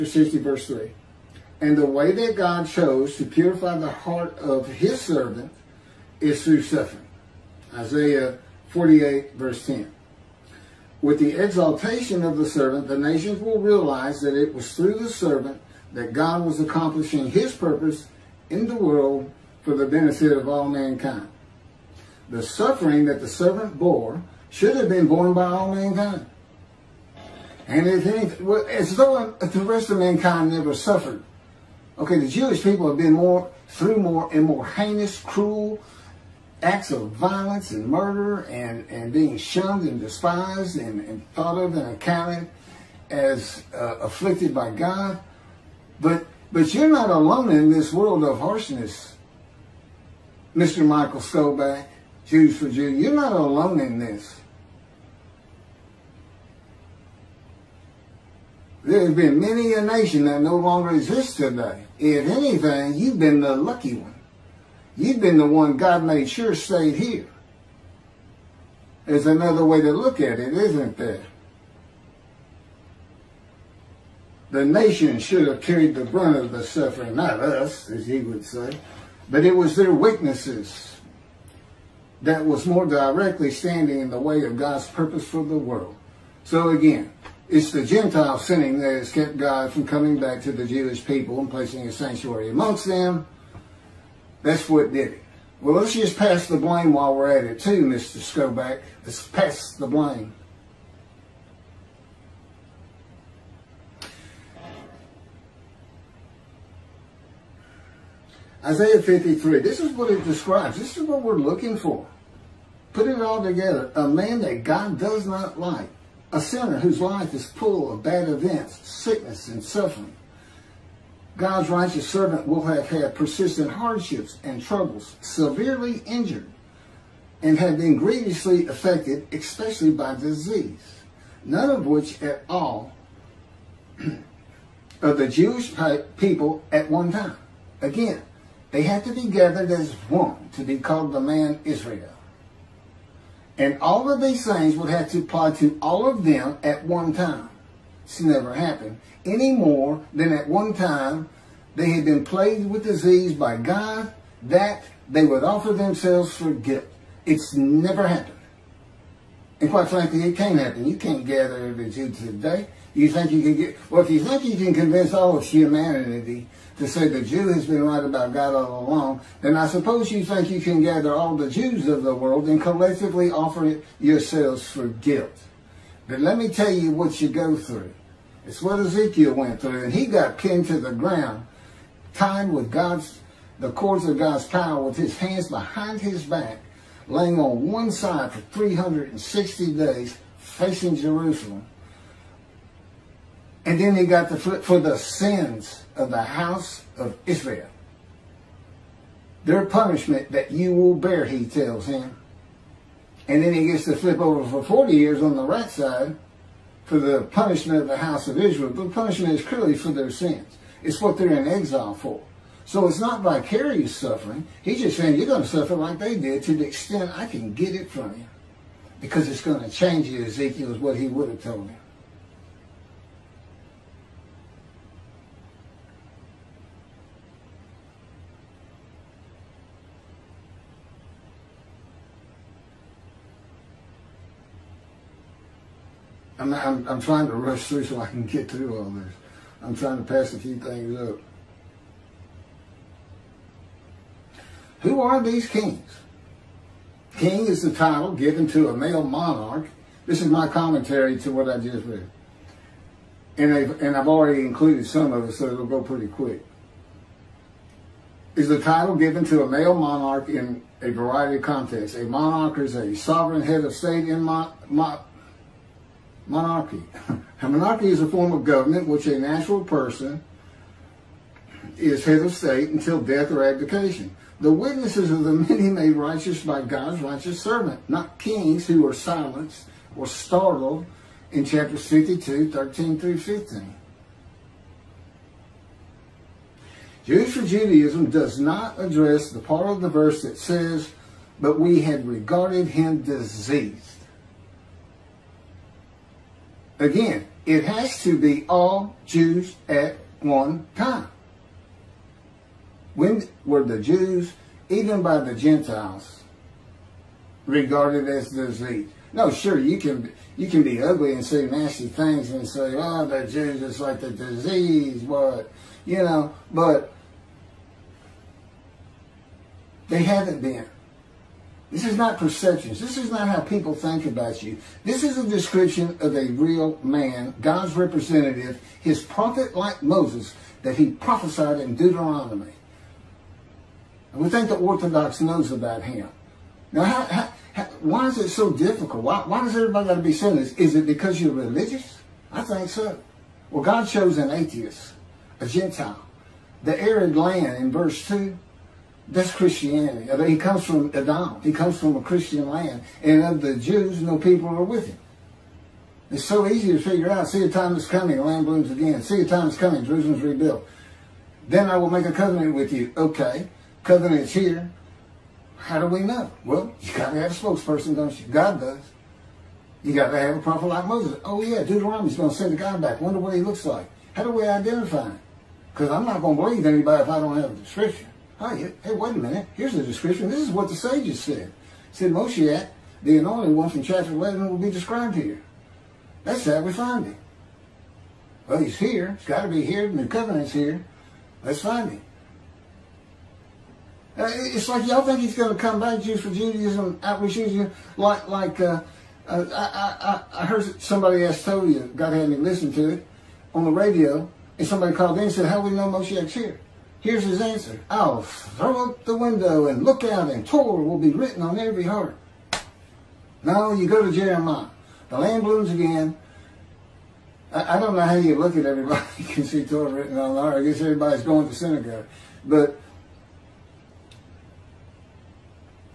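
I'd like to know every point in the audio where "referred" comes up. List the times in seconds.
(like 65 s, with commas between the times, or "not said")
not said.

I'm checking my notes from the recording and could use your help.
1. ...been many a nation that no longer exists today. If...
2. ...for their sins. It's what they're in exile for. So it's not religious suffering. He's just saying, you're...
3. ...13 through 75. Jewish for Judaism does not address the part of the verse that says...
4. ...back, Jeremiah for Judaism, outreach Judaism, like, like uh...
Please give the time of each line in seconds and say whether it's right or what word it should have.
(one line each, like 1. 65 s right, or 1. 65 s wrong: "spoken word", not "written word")
1. 59 s right
2. 209 s wrong: "vicarious", not "religious"
3. 282 s wrong: "15", not "75"
4. 395 s wrong: "Jews", not "Jeremiah".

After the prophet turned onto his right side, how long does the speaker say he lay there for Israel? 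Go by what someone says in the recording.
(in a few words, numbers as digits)
40 years.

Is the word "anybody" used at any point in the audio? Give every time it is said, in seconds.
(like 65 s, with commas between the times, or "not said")
376 s.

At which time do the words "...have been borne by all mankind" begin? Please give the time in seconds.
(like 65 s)
24 s.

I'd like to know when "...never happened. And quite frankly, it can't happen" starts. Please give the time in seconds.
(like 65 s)
157 s.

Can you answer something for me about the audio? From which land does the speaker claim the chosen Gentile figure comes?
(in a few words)
Edom.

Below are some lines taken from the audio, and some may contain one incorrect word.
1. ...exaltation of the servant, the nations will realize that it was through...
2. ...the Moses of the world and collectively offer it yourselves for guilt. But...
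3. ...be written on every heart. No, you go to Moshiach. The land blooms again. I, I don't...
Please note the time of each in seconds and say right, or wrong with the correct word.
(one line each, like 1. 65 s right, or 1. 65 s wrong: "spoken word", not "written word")
1. 11 s right
2. 171 s wrong: "Jews", not "Moses"
3. 410 s wrong: "Jeremiah", not "Moshiach".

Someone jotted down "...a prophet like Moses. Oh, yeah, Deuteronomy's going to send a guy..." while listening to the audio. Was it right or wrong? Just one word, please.
right.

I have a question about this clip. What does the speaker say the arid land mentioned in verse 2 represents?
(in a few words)
Christianity.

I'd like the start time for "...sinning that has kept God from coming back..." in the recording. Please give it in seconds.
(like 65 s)
88 s.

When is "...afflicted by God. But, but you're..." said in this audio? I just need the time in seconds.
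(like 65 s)
44 s.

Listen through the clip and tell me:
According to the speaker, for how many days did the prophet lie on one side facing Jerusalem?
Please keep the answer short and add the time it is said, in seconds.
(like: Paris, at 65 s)
360, at 188 s.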